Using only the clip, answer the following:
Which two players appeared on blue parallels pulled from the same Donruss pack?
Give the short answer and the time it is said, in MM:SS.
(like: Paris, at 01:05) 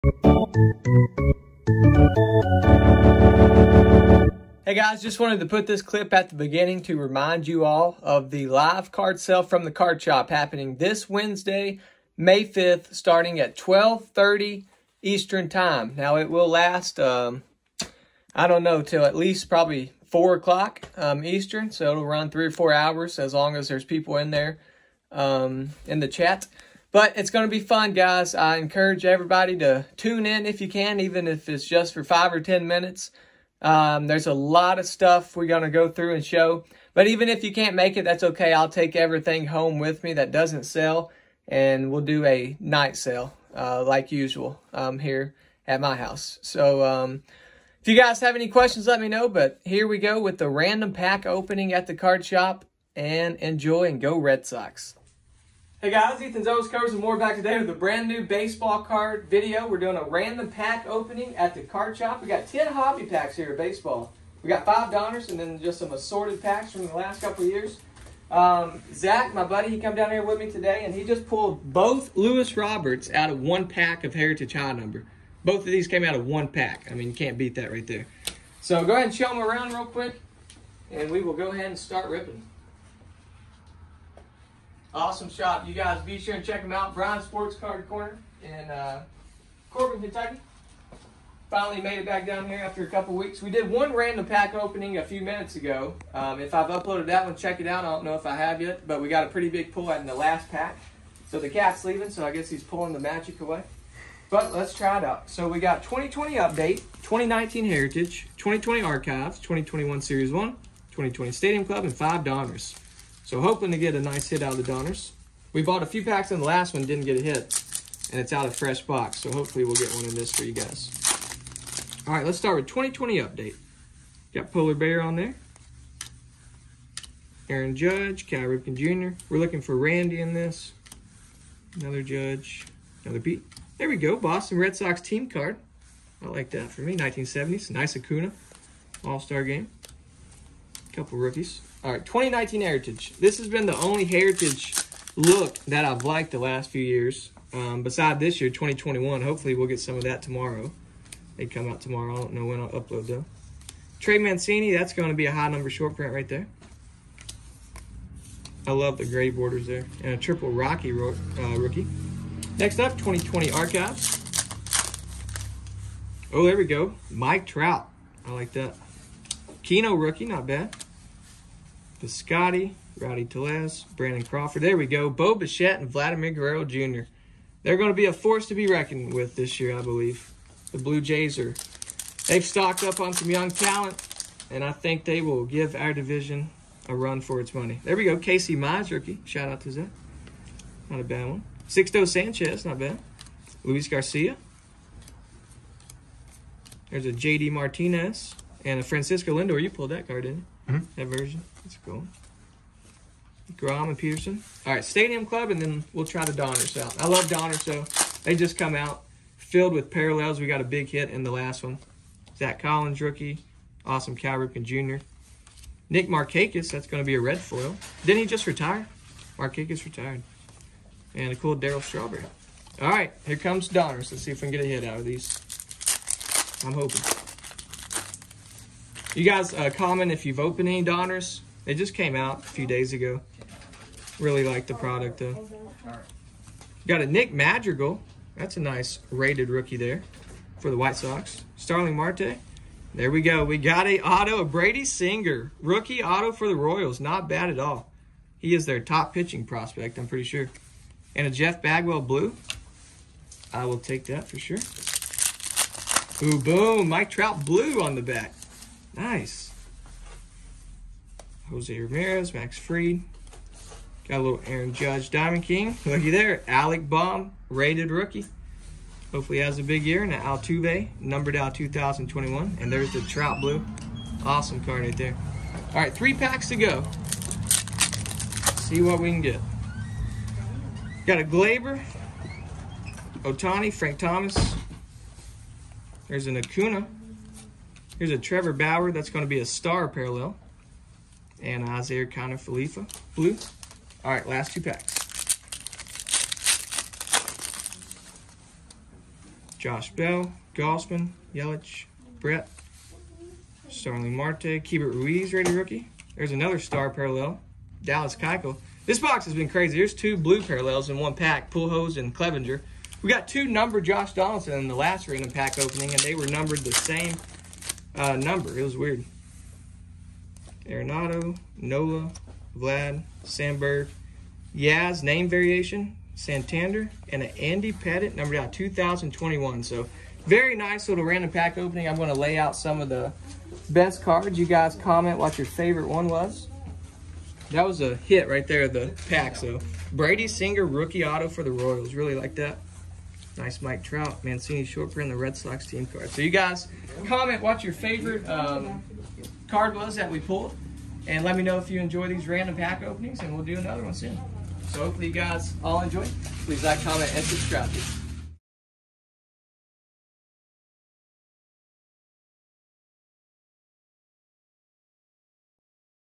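Pujols and Clevenger, at 05:11.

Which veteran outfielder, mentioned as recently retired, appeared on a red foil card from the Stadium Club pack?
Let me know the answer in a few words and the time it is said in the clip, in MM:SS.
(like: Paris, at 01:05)
Nick Markakis, at 03:35.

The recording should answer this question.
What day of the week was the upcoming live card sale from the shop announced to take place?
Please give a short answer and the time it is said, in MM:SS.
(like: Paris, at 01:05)
Wednesday, at 00:11.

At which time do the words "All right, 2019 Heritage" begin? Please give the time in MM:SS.
02:21.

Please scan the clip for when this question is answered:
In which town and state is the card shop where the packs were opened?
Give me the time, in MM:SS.
01:29.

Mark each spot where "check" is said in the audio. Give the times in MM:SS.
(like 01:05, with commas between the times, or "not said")
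01:26, 01:37.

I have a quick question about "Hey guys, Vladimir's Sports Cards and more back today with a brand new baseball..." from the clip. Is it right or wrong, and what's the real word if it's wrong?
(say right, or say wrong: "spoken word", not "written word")
wrong: "Ethan", not "Vladimir".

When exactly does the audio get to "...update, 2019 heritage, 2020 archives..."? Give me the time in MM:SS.
01:46.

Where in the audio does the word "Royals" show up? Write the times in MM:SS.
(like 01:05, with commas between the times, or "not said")
04:06, 05:41.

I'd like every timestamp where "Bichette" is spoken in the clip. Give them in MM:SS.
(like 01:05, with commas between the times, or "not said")
02:55.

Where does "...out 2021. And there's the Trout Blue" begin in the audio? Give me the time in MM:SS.
04:31.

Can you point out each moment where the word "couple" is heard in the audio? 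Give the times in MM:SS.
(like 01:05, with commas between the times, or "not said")
01:07, 01:32, 02:20.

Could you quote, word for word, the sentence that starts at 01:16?
I mean, you can't beat that right there.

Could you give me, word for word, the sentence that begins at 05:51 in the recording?
And let me know if you enjoy these random pack openings, and we'll do another one soon.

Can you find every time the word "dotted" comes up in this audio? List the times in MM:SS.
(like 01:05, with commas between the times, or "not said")
not said.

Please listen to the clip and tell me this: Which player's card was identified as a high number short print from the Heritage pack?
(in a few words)
Trey Mancini.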